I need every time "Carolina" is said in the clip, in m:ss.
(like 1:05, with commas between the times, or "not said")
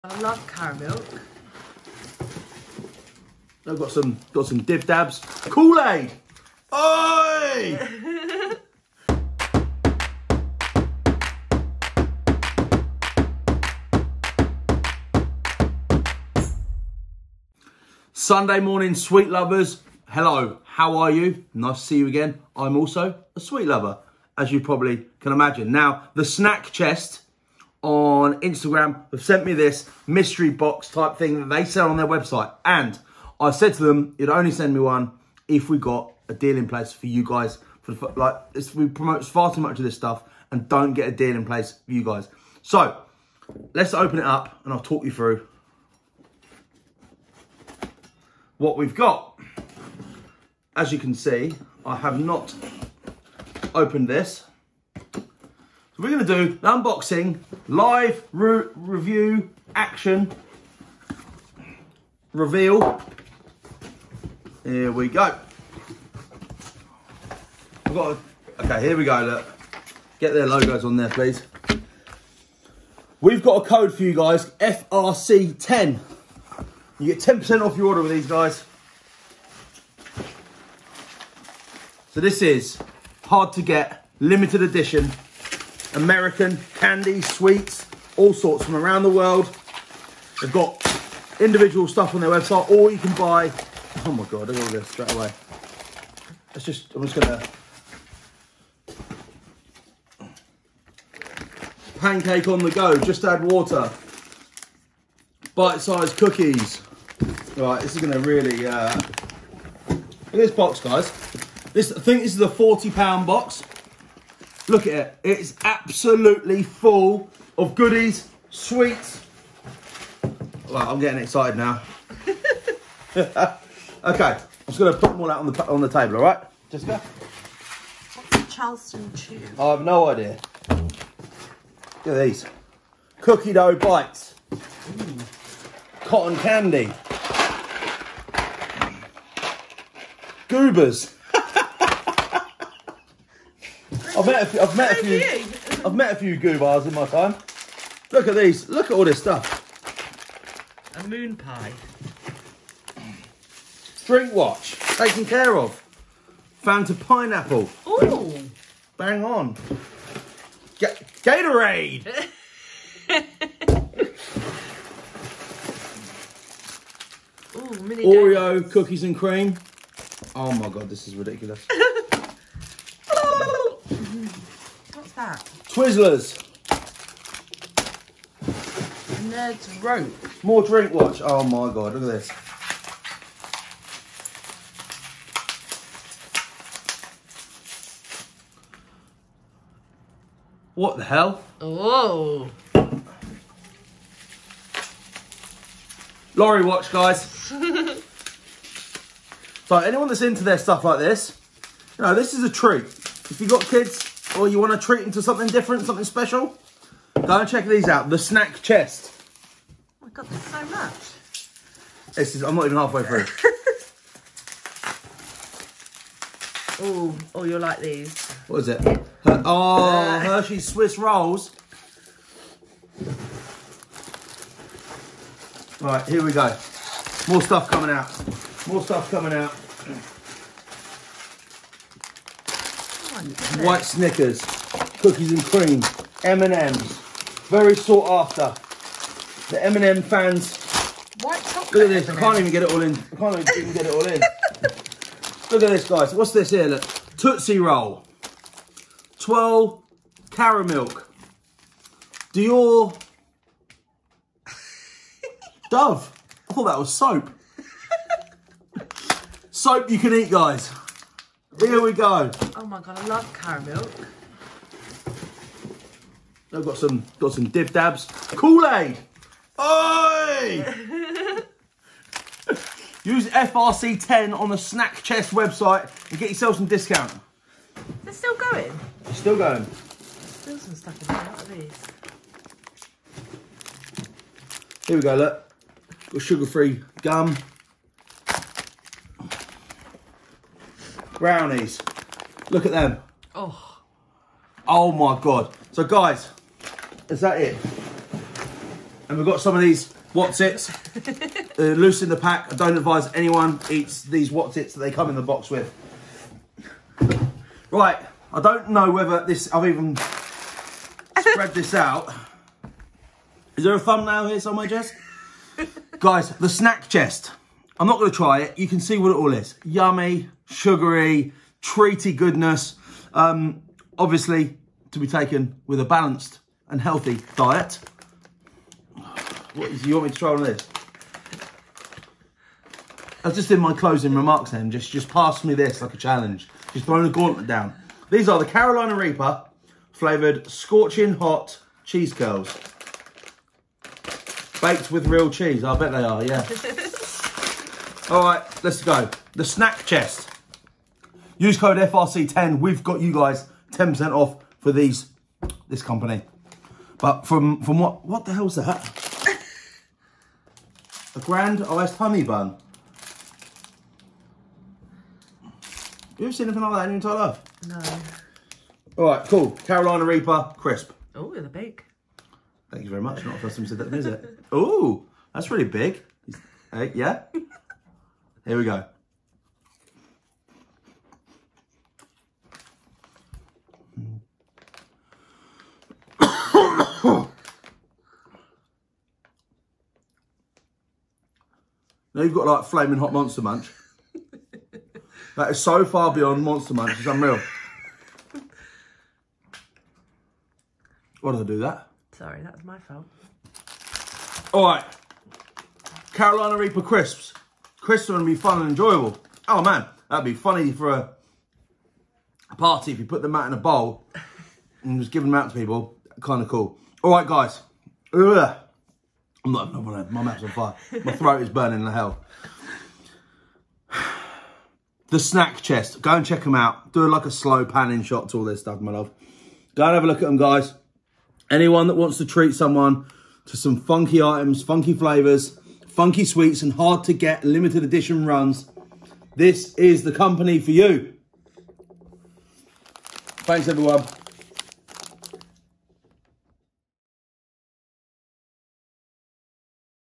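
5:38, 6:09, 6:46.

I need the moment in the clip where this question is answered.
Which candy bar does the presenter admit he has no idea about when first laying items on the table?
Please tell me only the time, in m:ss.
2:08.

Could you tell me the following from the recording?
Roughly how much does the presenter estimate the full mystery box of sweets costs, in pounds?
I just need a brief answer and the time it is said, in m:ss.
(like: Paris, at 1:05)
40 pounds, at 1:52.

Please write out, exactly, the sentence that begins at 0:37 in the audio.
For the, like, we promote far too much of this stuff and don't get a deal in place for you guys.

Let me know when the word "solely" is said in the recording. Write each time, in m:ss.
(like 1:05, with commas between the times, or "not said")
not said.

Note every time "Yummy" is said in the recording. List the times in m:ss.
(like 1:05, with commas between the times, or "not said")
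5:19.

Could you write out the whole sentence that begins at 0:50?
As you can see, I have not opened this we're going to do an unboxing, live re review, action, reveal.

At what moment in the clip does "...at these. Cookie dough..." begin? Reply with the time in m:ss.
2:12.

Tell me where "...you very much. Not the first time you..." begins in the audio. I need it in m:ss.
6:12.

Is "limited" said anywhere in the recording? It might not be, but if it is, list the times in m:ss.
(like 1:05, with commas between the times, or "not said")
1:24, 7:17.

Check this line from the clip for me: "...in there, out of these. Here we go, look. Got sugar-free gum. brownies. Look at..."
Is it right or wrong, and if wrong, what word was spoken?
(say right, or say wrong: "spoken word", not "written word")
right.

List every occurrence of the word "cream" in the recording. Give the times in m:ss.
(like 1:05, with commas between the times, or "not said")
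2:49, 3:55.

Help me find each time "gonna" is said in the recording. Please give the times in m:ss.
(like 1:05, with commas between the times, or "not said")
1:37, 1:48.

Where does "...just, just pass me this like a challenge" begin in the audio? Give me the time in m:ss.
5:34.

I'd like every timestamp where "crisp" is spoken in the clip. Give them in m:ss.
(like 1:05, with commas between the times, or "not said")
6:10, 6:46.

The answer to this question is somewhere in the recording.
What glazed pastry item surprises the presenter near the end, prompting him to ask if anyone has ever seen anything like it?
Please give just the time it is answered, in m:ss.
6:01.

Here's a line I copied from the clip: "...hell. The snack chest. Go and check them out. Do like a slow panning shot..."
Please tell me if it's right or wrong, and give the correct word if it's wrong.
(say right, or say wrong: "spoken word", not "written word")
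right.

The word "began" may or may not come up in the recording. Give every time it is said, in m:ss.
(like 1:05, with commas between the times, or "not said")
not said.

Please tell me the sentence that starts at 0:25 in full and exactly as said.
Now, the snack chest on Instagram have sent me this mystery box type thing that they sell on their website.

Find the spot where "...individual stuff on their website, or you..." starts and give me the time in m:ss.
1:31.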